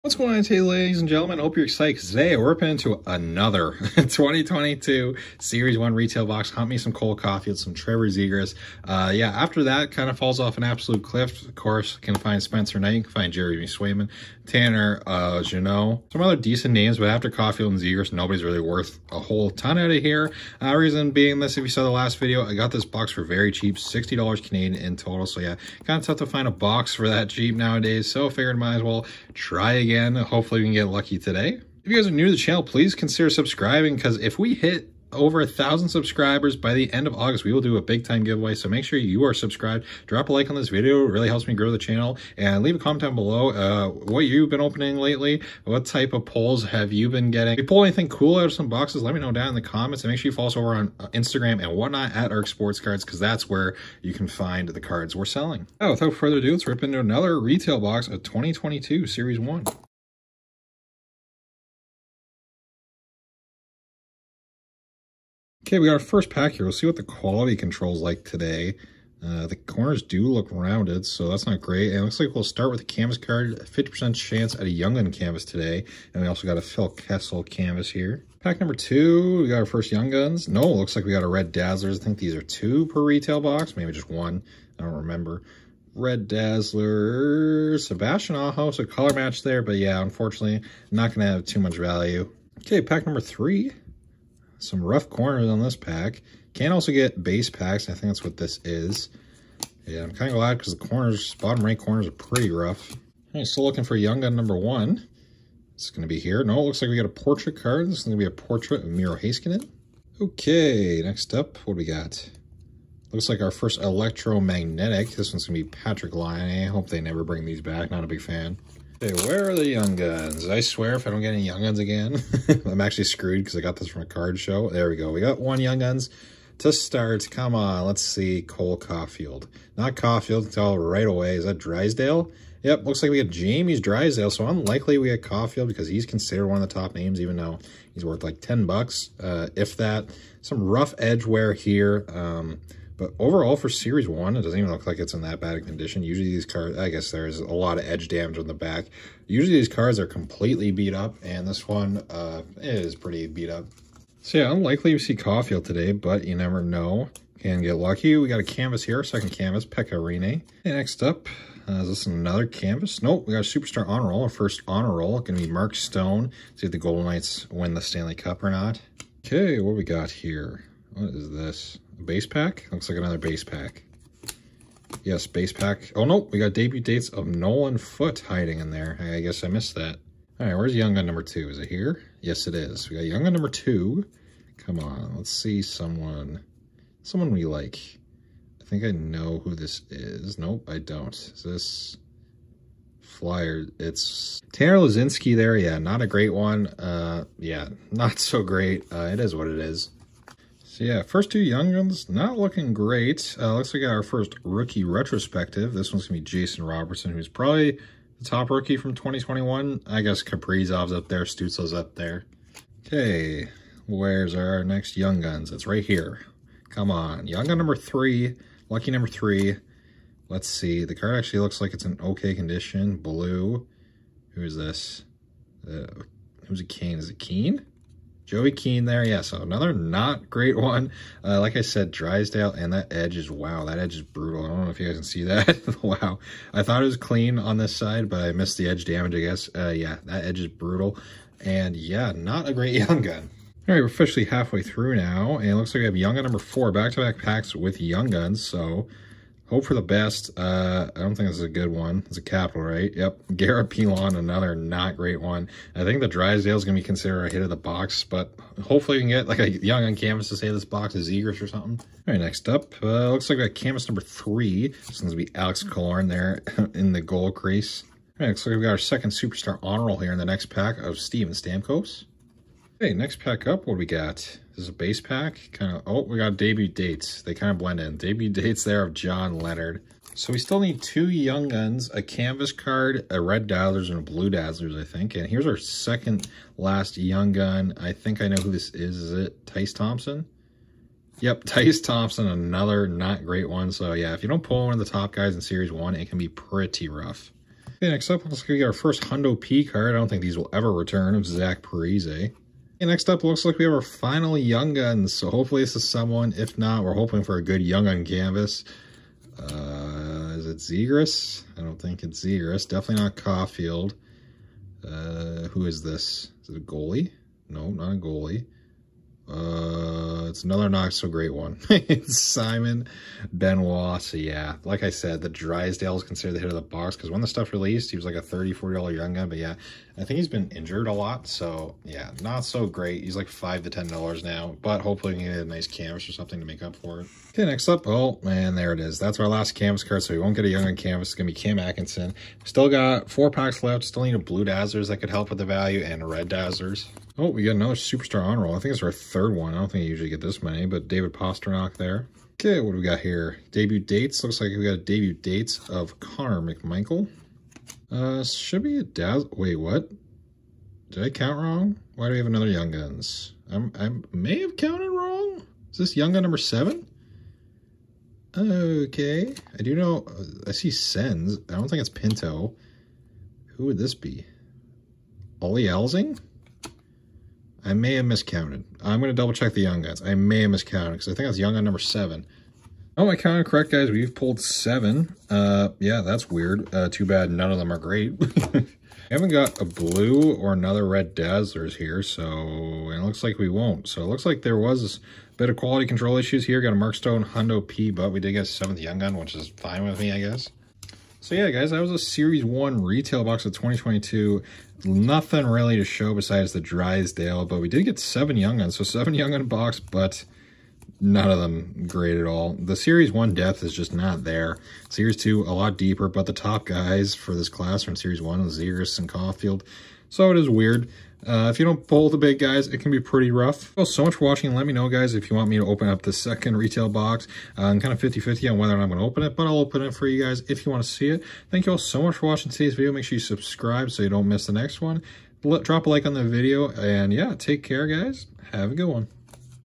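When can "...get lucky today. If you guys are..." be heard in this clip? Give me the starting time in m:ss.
0:30.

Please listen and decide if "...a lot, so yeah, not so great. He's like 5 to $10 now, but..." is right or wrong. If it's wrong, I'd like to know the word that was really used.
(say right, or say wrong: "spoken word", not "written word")
right.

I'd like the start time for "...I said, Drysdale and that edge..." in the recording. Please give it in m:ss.
3:51.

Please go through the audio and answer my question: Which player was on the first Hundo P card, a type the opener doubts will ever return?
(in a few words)
Zach Parise.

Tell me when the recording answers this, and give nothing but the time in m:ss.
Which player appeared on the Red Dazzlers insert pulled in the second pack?
1:27.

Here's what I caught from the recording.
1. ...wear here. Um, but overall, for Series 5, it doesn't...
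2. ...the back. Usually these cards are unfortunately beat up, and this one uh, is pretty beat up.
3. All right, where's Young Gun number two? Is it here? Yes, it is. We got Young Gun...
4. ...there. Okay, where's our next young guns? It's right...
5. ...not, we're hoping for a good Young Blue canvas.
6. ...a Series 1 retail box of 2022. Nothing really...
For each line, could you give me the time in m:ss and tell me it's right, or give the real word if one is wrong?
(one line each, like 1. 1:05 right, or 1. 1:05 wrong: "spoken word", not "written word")
1. 2:21 wrong: "1", not "5"
2. 2:28 wrong: "completely", not "unfortunately"
3. 3:00 right
4. 3:31 right
5. 5:06 wrong: "Gun", not "Blue"
6. 6:41 right.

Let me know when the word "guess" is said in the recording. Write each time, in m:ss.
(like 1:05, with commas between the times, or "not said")
2:26, 2:59, 3:30, 3:59, 6:40.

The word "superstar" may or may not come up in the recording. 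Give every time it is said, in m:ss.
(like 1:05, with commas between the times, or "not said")
2:43, 4:29, 5:47.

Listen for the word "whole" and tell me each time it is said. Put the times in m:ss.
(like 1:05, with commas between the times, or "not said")
0:19.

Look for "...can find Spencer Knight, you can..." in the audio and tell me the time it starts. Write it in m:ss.
0:11.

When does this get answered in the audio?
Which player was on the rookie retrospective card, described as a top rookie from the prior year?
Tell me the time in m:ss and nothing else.
3:26.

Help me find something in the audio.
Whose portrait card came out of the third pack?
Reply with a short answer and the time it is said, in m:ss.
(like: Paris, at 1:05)
Miro Heiskanen, at 1:48.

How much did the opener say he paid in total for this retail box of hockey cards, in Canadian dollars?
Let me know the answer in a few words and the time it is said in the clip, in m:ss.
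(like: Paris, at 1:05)
$60, at 0:23.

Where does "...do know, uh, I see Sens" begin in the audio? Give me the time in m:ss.
6:09.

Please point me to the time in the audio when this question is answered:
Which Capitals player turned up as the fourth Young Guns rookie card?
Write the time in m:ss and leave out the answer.
4:13.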